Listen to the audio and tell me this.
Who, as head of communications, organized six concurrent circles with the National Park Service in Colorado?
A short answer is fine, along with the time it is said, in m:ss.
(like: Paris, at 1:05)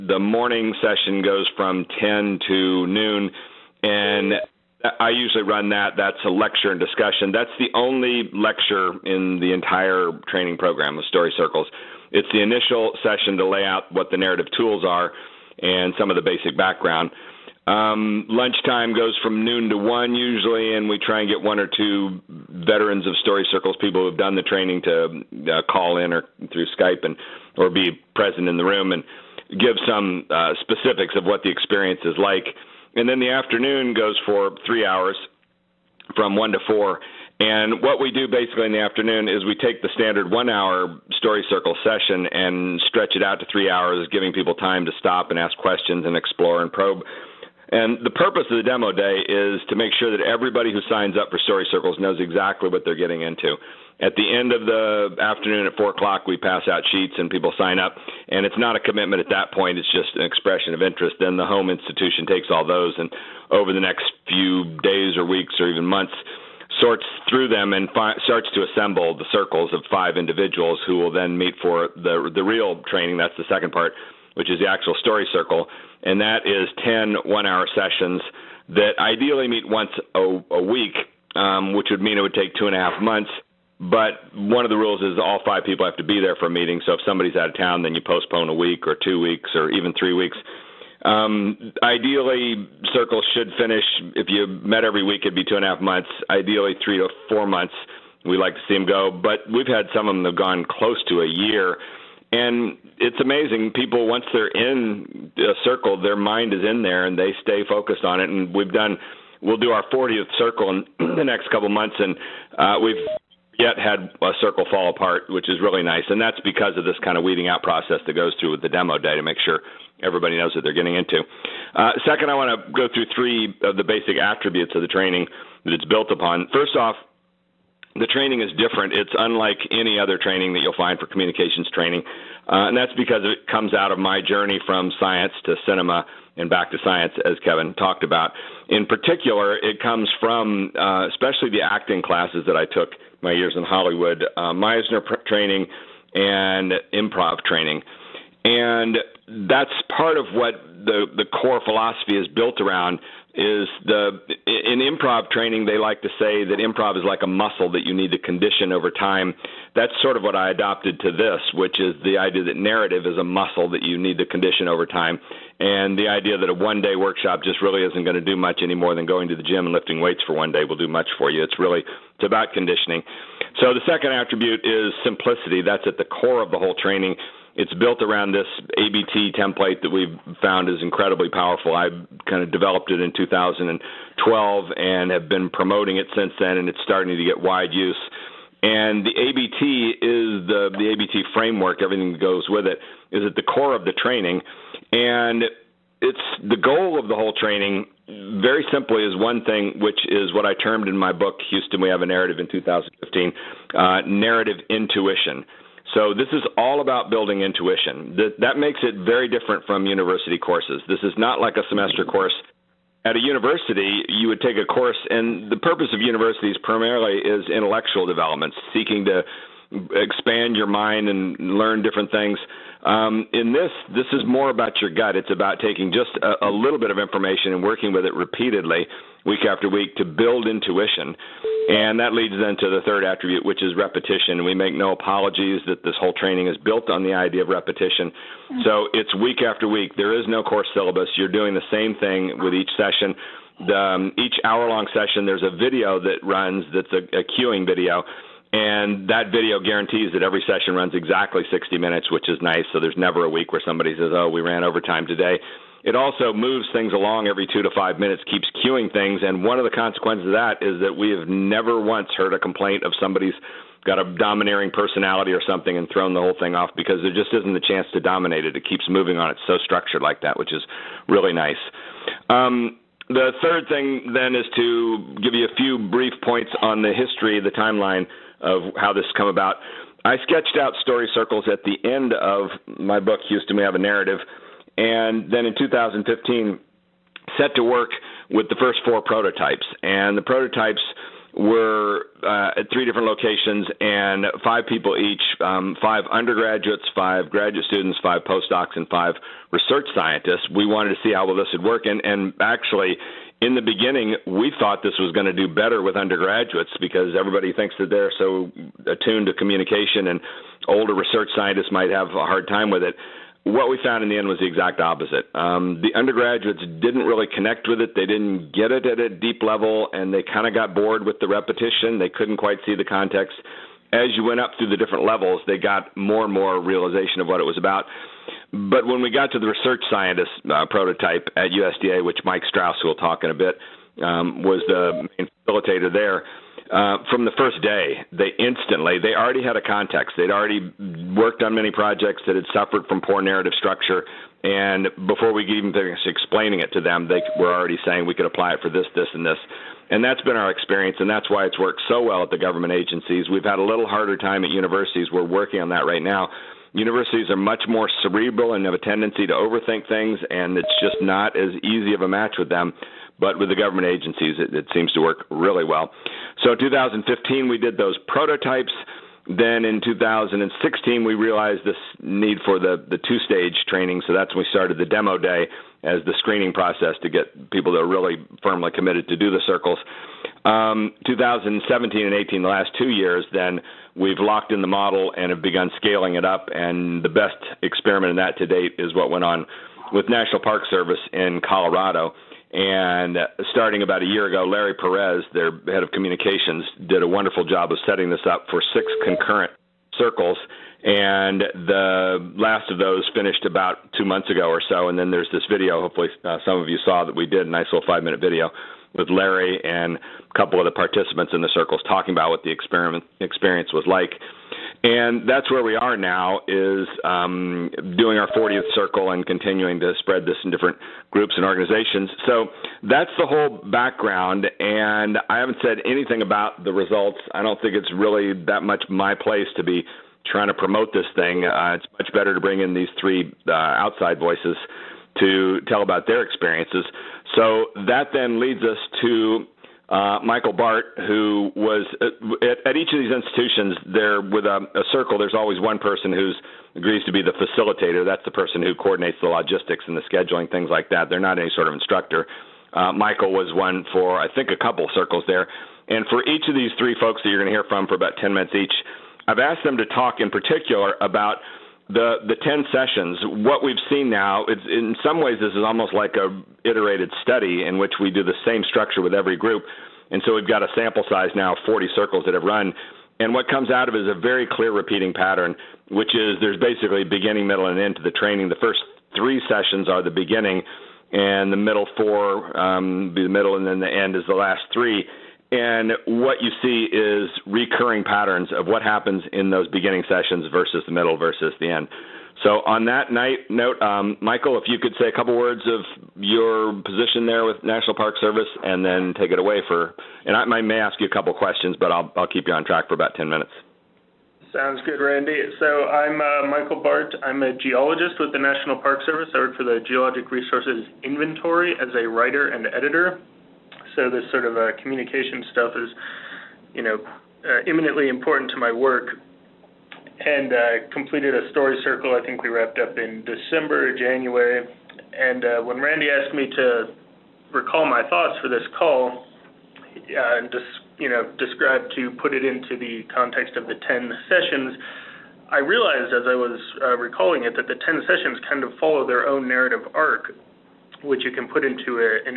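Larry Perez, at 6:34.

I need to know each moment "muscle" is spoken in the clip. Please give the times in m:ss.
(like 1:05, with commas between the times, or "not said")
2:37, 2:43.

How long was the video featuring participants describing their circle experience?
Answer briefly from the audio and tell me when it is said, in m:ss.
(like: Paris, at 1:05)
5 minutes, at 6:47.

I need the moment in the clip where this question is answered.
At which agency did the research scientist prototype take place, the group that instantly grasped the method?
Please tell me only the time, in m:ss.
5:31.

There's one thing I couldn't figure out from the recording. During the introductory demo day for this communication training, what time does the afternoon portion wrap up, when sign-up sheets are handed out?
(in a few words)
4 o'clock.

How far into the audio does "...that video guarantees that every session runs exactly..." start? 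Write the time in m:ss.
4:09.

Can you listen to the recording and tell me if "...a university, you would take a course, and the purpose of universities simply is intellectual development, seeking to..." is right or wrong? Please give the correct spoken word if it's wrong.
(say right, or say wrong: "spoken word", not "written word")
wrong: "primarily", not "simply".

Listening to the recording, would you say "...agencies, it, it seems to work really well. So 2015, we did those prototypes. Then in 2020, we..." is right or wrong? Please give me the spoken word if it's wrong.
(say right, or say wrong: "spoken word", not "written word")
wrong: "2016", not "2020".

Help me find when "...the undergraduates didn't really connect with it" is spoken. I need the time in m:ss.
5:15.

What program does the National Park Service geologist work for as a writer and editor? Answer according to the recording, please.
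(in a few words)
Geologic Resources Inventory.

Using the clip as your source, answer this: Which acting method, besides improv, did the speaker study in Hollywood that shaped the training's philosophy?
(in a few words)
Meisner training.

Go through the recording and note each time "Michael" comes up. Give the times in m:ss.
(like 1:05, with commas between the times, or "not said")
7:20, 7:32, 8:14, 8:26.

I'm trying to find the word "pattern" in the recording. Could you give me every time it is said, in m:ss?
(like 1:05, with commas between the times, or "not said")
7:55, 8:08.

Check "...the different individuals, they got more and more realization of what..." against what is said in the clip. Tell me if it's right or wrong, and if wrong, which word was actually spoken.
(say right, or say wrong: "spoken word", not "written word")
wrong: "levels", not "individuals".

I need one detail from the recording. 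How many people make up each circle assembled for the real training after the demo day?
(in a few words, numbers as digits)
5.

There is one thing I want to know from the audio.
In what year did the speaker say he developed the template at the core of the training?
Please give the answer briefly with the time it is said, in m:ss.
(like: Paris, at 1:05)
2012, at 3:03.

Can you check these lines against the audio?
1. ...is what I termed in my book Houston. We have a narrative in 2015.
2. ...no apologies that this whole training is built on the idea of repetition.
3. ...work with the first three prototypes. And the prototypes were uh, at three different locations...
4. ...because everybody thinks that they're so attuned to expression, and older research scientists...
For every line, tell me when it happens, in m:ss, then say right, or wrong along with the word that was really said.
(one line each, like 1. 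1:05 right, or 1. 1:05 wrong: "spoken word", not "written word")
1. 3:20 right
2. 3:54 right
3. 4:47 wrong: "four", not "three"
4. 5:06 wrong: "communication", not "expression".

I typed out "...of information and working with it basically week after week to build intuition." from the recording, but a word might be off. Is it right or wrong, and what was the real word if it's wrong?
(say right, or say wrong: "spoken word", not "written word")
wrong: "repeatedly", not "basically".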